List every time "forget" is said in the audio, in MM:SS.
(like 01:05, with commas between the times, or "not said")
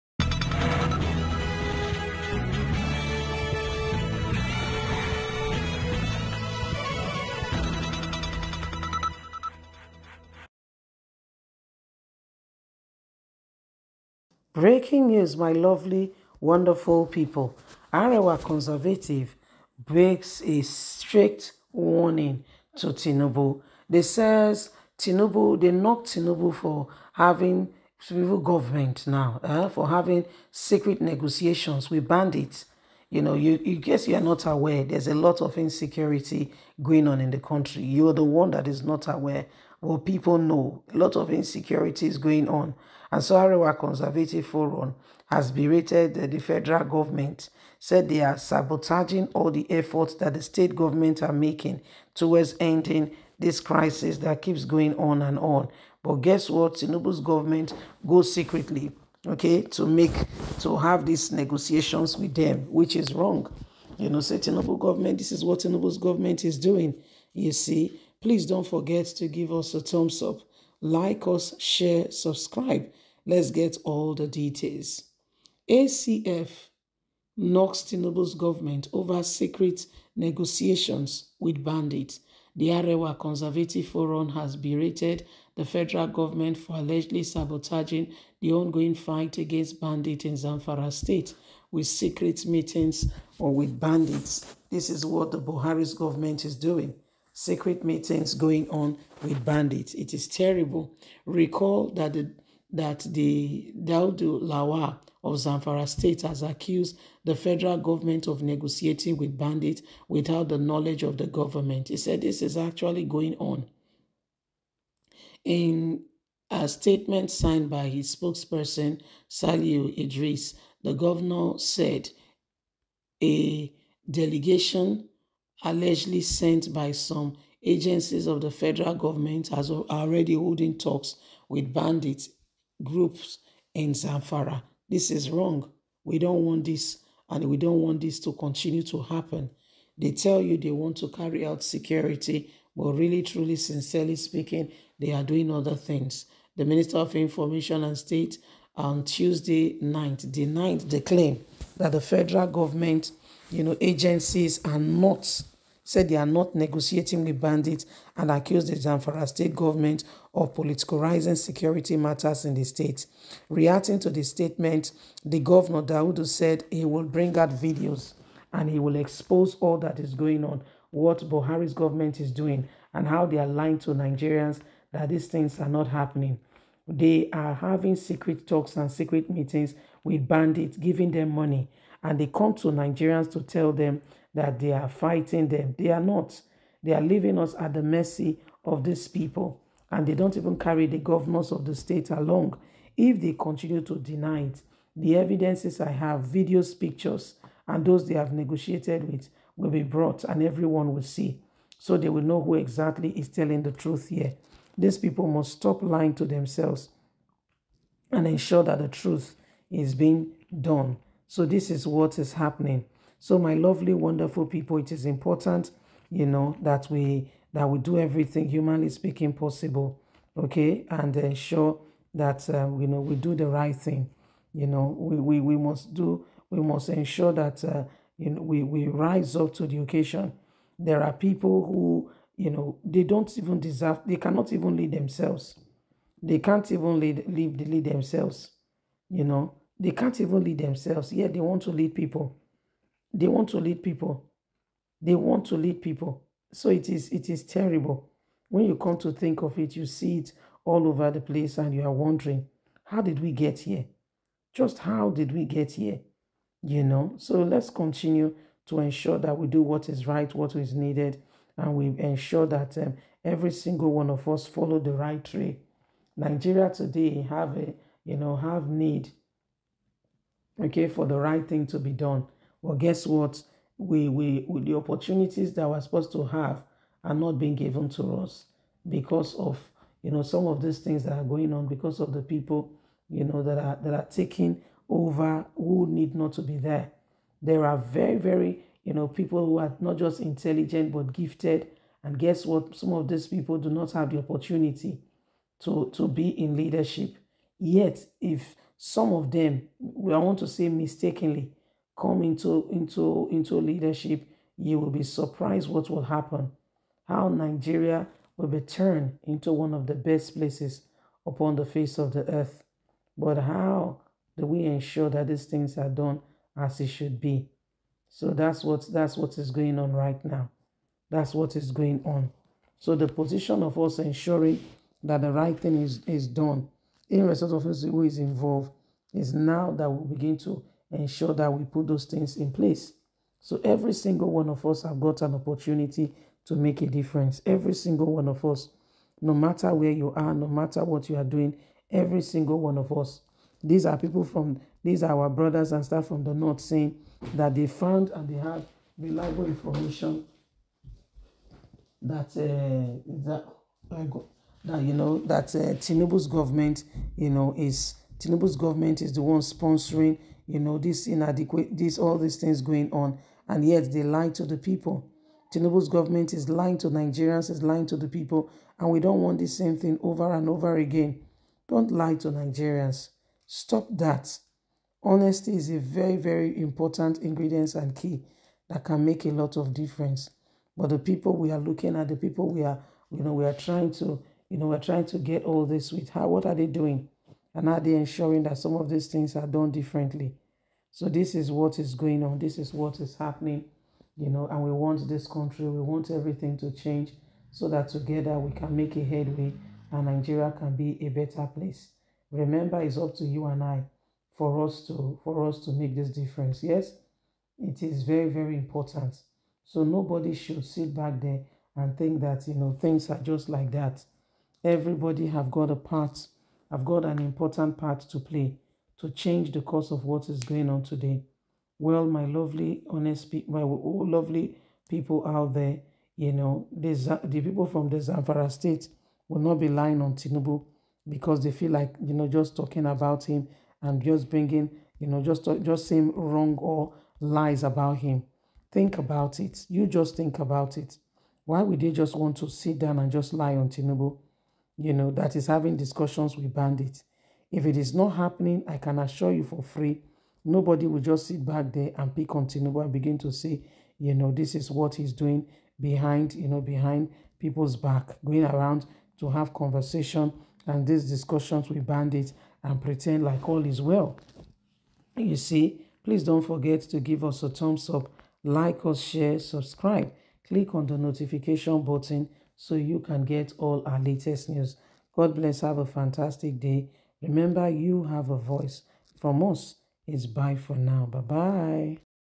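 01:08, 07:46.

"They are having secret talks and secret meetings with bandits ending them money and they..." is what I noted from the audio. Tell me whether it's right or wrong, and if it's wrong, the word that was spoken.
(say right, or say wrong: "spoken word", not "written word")
wrong: "giving", not "ending".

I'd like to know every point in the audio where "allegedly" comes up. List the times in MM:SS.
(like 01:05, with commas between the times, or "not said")
01:26, 02:05.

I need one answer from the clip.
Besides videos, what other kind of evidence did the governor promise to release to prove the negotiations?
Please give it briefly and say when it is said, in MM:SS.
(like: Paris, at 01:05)
Pictures, at 03:16.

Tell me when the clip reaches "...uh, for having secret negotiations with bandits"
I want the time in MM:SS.
00:29.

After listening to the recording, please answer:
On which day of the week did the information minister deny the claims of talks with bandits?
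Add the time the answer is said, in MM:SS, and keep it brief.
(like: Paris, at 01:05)
Tuesday, at 02:29.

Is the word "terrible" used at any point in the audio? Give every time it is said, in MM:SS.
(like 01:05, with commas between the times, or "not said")
01:40, 04:07.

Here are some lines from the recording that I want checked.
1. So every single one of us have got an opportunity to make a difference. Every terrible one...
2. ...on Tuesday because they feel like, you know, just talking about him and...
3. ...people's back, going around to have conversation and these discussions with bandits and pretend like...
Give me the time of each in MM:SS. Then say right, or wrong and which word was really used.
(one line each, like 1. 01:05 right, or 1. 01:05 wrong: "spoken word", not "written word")
1. 05:33 wrong: "single", not "terrible"
2. 07:09 wrong: "Tinubu", not "Tuesday"
3. 07:37 right.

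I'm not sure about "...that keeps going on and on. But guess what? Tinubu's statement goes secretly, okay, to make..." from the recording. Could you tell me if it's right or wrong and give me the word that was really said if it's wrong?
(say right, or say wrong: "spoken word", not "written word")
wrong: "government", not "statement".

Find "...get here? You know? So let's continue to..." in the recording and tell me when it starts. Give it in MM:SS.
04:15.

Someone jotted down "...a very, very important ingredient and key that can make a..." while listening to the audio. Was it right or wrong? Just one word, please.
right.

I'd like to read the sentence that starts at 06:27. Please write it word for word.
And are they ensuring that some of these things are done differently?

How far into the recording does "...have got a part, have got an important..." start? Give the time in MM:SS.
06:55.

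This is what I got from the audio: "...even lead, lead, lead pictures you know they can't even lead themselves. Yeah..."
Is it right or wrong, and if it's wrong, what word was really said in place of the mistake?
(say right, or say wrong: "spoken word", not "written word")
wrong: "themselves", not "pictures".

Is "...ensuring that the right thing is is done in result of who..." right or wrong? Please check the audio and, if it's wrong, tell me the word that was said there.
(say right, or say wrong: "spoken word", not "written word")
right.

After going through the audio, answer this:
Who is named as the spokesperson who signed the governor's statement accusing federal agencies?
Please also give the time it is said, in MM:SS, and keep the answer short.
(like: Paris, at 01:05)
Saliu Idris, at 01:59.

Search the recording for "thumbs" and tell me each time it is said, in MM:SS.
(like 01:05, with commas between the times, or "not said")
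01:09, 07:47.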